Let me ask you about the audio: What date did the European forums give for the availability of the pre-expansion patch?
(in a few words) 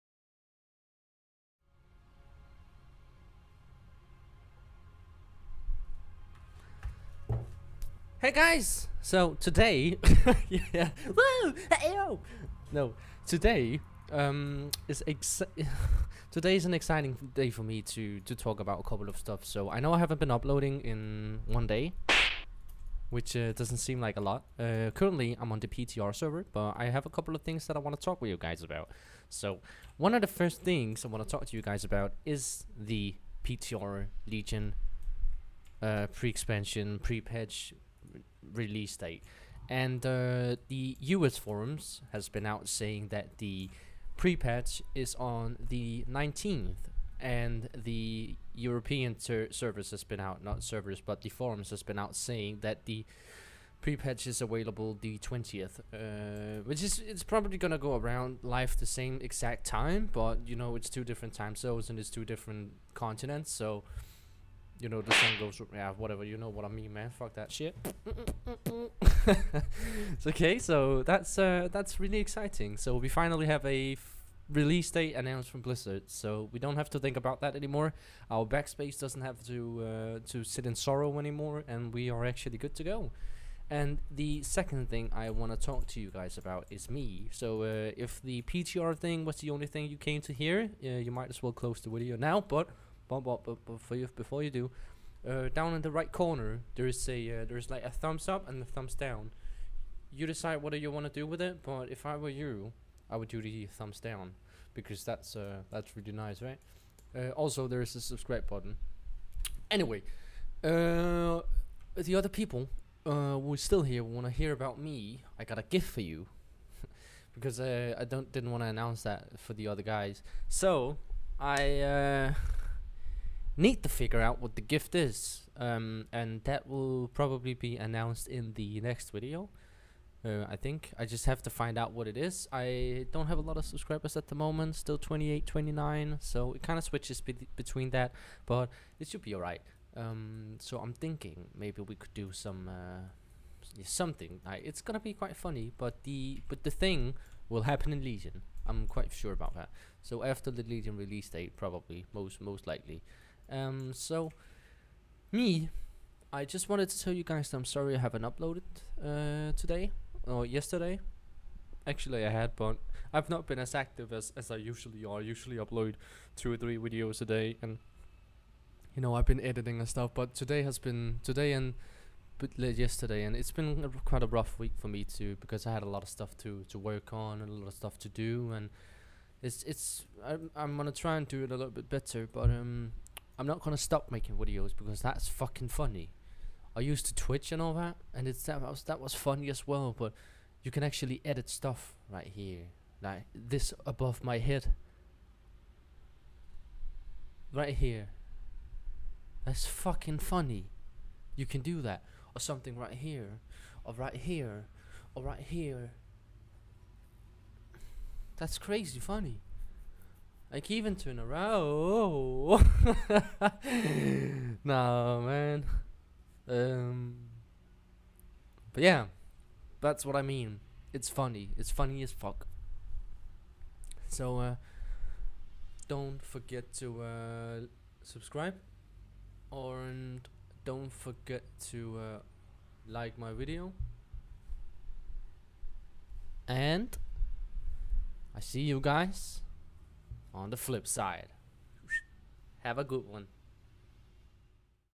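20th.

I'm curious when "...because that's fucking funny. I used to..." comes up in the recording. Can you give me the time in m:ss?
3:04.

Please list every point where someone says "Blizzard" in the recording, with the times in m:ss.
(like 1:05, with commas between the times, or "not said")
1:15.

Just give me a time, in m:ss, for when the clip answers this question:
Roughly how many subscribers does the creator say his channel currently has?
2:14.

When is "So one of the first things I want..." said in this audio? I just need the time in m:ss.
0:29.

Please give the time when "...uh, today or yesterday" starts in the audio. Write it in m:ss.
2:38.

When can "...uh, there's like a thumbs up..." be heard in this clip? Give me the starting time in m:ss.
1:37.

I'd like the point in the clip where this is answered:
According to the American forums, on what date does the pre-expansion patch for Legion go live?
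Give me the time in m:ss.
0:46.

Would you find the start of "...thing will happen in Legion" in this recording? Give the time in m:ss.
2:26.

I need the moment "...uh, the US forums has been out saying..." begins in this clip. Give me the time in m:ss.
0:40.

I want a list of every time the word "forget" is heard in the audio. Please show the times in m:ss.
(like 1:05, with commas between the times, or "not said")
3:46, 3:50.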